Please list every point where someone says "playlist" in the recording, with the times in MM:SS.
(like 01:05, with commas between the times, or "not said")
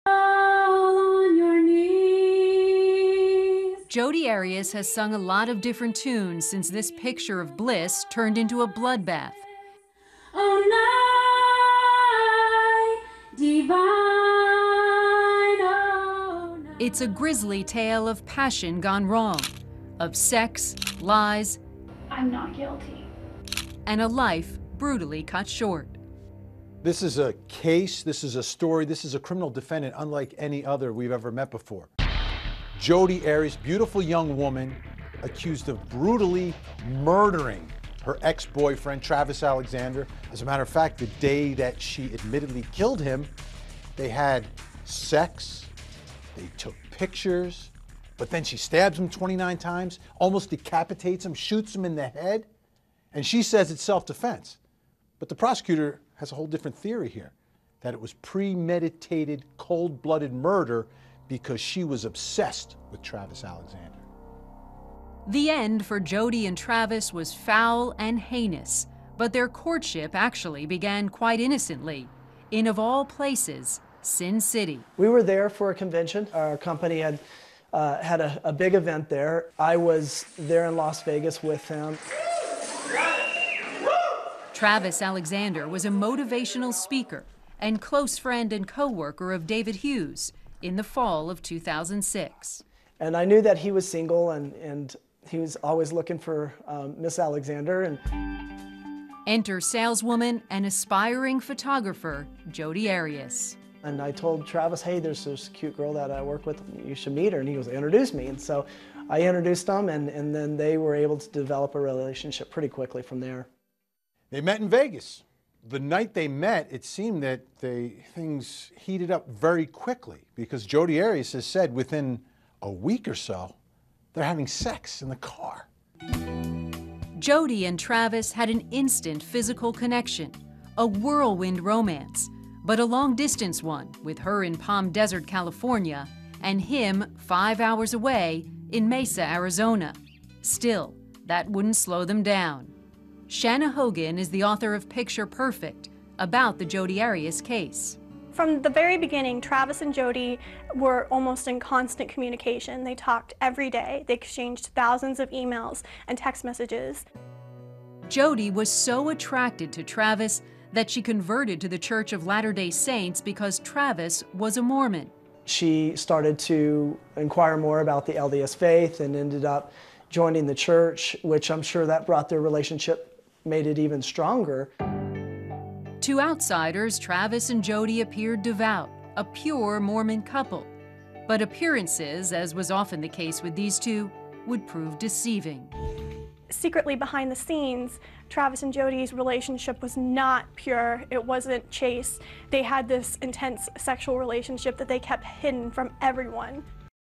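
not said.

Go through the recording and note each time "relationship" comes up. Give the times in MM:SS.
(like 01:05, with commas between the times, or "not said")
01:51, 02:52, 03:09, 03:14.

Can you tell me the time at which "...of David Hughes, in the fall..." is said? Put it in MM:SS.
01:29.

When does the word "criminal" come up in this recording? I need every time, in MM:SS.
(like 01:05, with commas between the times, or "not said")
00:29.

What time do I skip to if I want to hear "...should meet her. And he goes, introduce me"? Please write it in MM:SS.
01:46.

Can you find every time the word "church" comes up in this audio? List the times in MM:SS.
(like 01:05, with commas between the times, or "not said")
02:41, 02:50.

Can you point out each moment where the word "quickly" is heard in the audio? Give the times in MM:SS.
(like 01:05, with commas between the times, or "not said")
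01:52, 01:59.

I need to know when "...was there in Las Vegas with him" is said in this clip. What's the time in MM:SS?
01:19.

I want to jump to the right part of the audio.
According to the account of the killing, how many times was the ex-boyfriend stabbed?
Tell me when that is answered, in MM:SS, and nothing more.
00:49.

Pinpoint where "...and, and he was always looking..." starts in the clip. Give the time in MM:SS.
01:34.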